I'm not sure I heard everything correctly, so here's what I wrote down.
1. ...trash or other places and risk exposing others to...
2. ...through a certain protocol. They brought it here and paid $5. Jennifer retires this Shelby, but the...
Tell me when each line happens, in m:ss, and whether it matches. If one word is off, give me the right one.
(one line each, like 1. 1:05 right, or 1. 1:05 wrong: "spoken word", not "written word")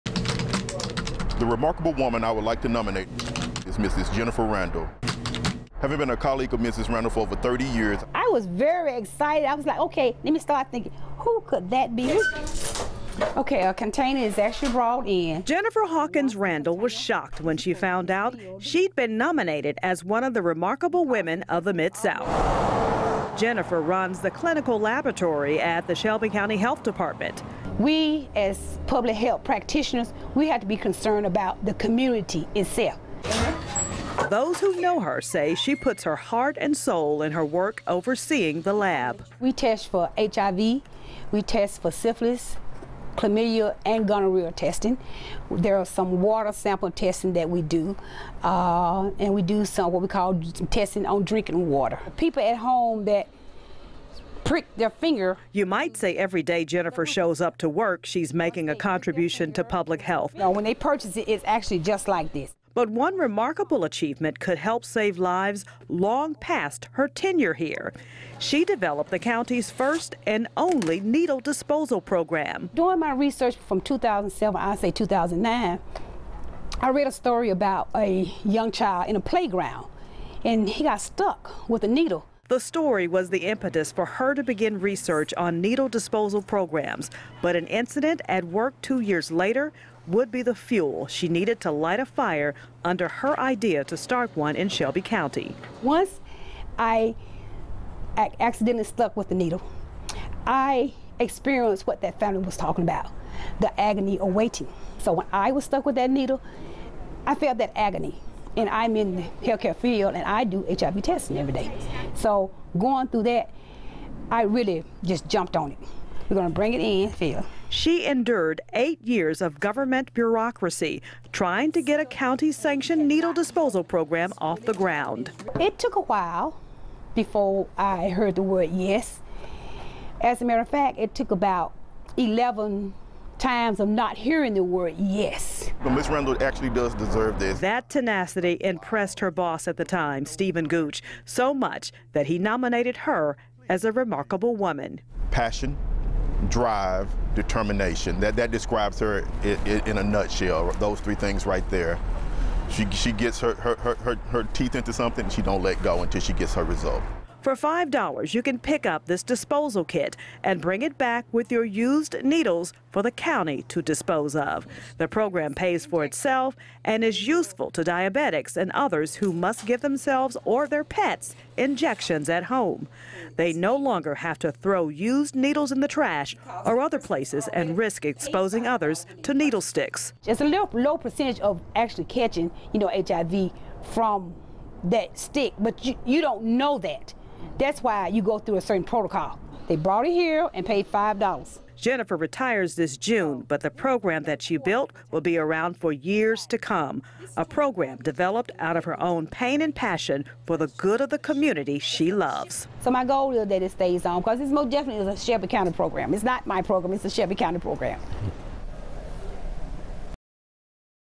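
1. 2:55 right
2. 3:08 wrong: "June", not "Shelby".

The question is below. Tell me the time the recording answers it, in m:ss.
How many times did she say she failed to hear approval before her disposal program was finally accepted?
2:12.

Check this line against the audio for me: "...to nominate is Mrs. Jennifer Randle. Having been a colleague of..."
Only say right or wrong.
right.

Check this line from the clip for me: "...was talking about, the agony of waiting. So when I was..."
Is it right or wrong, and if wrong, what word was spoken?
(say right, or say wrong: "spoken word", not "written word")
right.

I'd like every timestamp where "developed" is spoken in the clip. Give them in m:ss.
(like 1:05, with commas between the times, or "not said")
1:08, 3:17.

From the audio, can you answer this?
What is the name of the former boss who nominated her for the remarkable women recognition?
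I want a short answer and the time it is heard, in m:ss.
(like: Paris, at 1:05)
Stephen Gooch, at 2:20.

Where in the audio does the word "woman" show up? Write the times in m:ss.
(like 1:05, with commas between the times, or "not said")
0:01, 2:24.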